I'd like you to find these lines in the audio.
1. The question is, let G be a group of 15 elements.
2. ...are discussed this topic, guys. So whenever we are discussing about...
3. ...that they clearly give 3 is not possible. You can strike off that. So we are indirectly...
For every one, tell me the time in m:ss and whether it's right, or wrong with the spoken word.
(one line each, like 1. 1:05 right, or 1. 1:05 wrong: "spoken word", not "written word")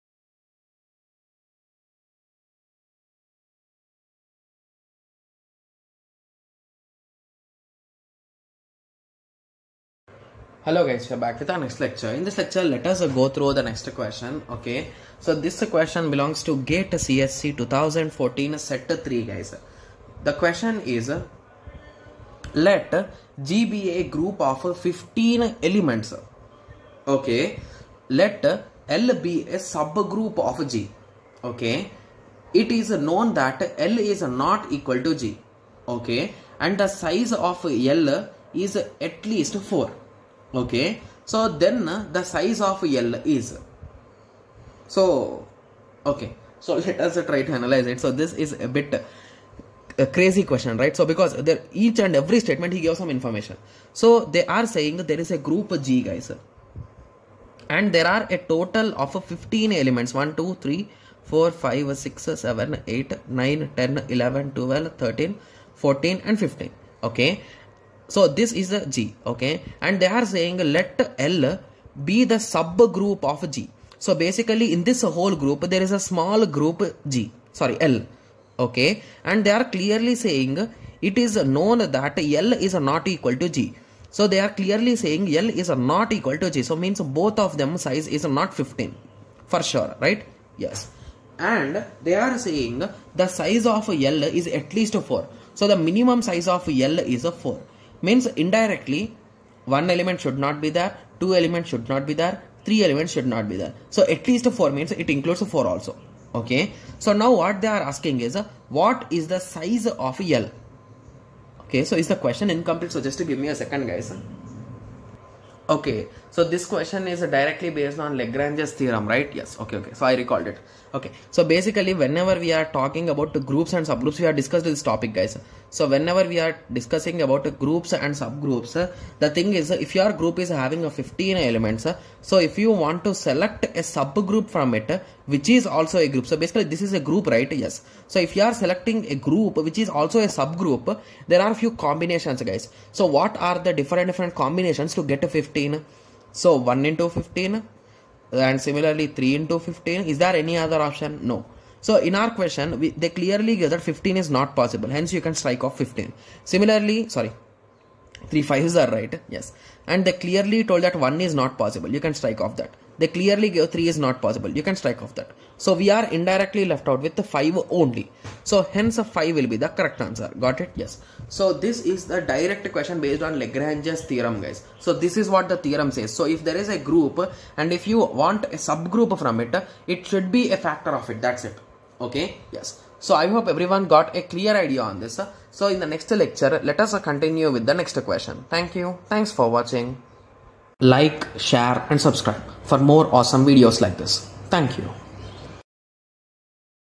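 1. 0:20 right
2. 2:04 right
3. 2:42 right.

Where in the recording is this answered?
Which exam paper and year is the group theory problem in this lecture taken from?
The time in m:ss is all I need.
0:16.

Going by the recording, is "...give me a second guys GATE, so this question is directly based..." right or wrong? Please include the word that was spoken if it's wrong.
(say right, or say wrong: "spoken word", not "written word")
wrong: "Okay", not "GATE".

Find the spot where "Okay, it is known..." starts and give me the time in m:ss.
0:31.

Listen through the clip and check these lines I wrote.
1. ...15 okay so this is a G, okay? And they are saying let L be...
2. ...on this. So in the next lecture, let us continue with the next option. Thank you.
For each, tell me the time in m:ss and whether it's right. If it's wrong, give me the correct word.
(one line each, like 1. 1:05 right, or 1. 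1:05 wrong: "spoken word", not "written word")
1. 1:06 right
2. 3:04 wrong: "question", not "option".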